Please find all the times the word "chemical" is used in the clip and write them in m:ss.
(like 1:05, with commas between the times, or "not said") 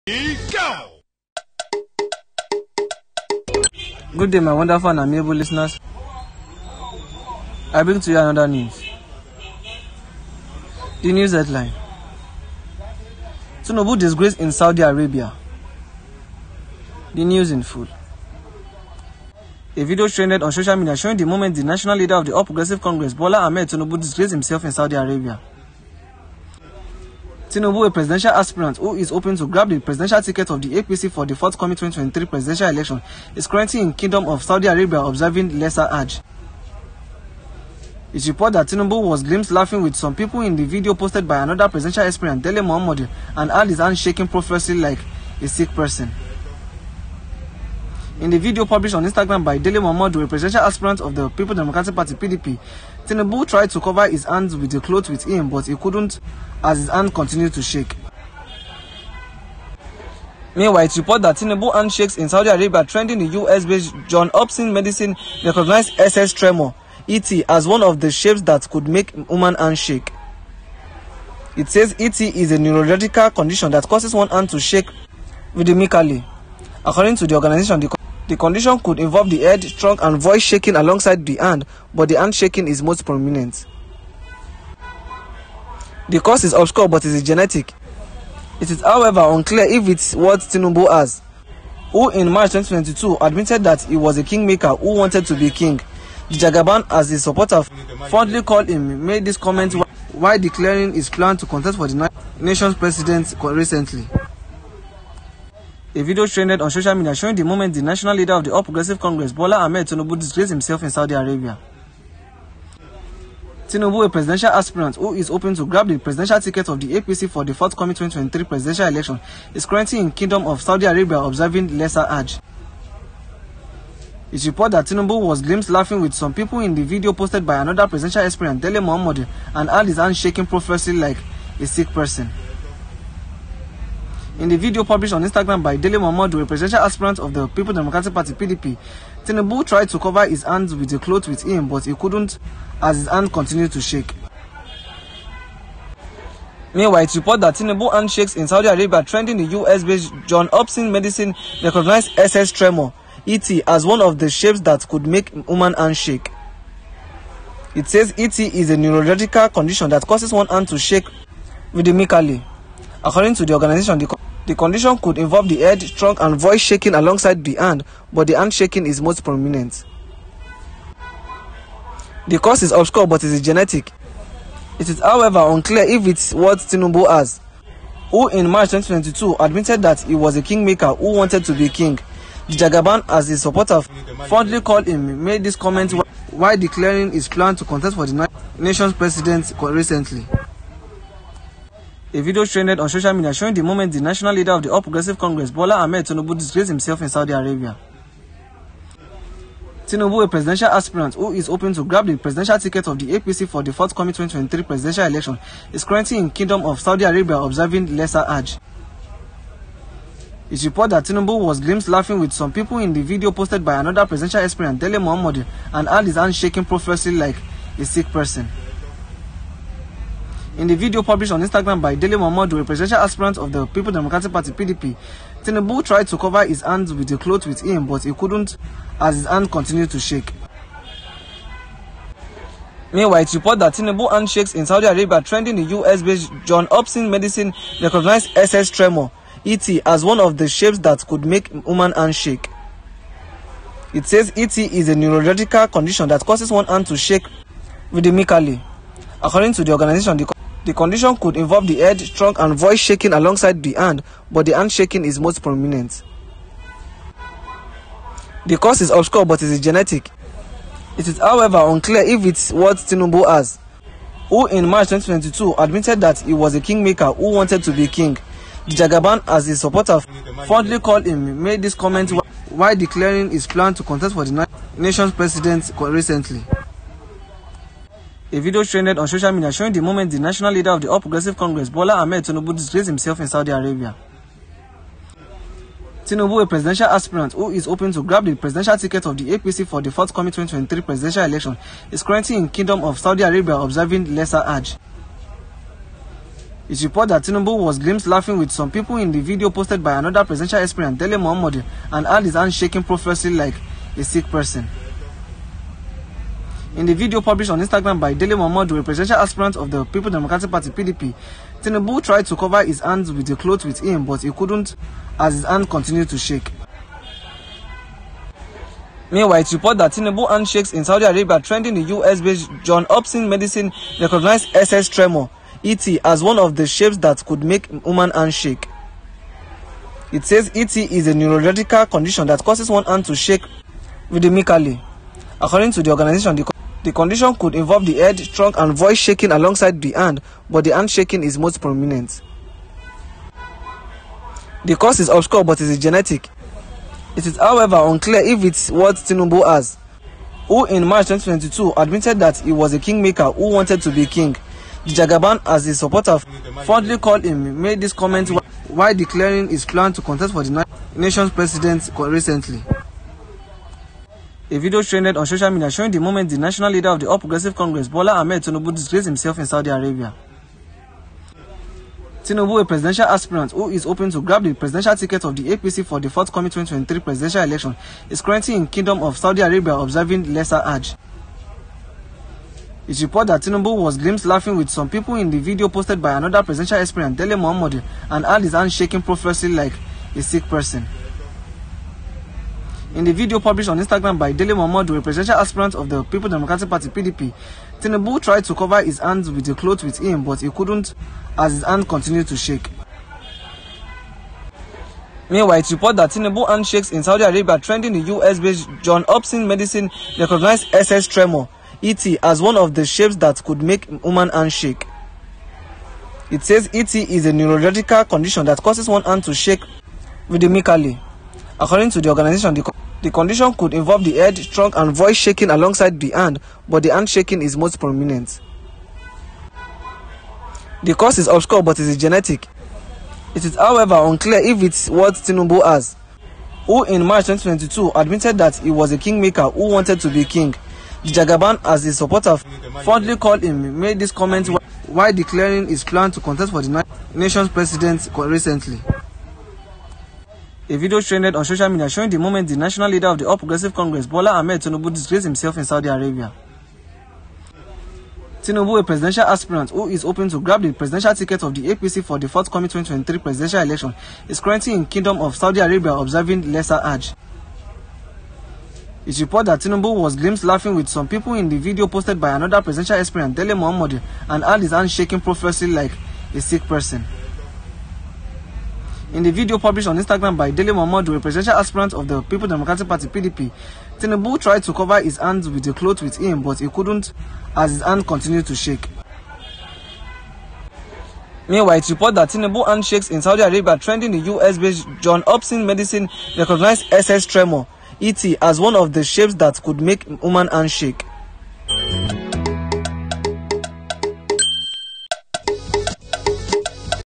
not said.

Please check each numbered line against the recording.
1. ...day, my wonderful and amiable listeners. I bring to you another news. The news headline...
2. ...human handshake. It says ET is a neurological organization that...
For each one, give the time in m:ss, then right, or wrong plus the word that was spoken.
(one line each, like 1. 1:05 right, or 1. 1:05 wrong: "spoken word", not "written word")
1. 0:04 right
2. 5:27 wrong: "condition", not "organization".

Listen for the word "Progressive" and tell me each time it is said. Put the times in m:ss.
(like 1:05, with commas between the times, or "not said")
0:22, 1:48, 3:14, 4:41, 6:07, 7:33.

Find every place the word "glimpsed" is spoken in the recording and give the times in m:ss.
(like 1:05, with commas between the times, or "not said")
0:39, 2:05, 3:31, 4:57, 6:23, 7:50.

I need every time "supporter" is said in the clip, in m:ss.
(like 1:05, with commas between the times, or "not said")
1:37, 3:03, 4:29, 5:55, 7:21.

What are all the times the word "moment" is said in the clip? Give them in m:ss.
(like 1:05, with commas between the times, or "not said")
0:21, 1:47, 3:13, 4:39, 6:06, 7:32.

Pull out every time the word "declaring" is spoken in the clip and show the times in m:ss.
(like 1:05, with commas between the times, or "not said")
1:40, 3:06, 4:32, 5:58, 7:25.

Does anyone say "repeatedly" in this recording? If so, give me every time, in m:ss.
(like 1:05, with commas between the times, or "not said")
not said.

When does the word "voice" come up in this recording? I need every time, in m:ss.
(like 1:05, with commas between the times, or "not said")
1:20, 2:46, 4:12, 5:38, 7:04.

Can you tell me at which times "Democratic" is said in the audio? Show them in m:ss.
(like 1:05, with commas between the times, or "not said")
0:51, 2:17, 3:43, 5:10, 6:36, 8:02.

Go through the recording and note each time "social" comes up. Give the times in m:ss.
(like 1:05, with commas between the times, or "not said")
0:20, 1:46, 3:12, 4:39, 6:05, 7:31.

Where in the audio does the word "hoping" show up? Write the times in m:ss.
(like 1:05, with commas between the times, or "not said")
0:29, 1:55, 3:21, 4:47, 6:13, 7:40.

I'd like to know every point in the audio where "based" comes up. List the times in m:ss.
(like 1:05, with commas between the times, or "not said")
1:03, 2:29, 3:55, 5:21, 6:48, 8:14.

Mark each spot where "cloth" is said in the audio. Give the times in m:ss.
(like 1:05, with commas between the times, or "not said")
0:54, 2:20, 3:47, 5:13, 6:39, 8:05.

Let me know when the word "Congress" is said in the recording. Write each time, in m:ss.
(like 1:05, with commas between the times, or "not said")
0:22, 1:48, 3:15, 4:41, 6:07, 7:33.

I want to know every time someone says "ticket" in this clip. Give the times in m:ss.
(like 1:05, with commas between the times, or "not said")
0:30, 1:56, 3:22, 4:48, 6:14, 7:41.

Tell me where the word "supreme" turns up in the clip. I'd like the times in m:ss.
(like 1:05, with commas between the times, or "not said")
not said.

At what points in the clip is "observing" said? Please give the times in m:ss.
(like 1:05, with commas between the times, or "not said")
0:35, 2:01, 3:27, 4:53, 6:19, 7:45.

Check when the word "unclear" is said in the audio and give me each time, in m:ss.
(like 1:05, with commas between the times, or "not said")
1:29, 2:55, 4:21, 5:47, 7:13.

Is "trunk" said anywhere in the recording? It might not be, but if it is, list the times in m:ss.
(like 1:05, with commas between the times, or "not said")
1:19, 2:45, 4:12, 5:38, 7:04.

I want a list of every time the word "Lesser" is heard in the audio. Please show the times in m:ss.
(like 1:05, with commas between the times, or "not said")
0:35, 2:01, 3:27, 4:54, 6:20, 7:46.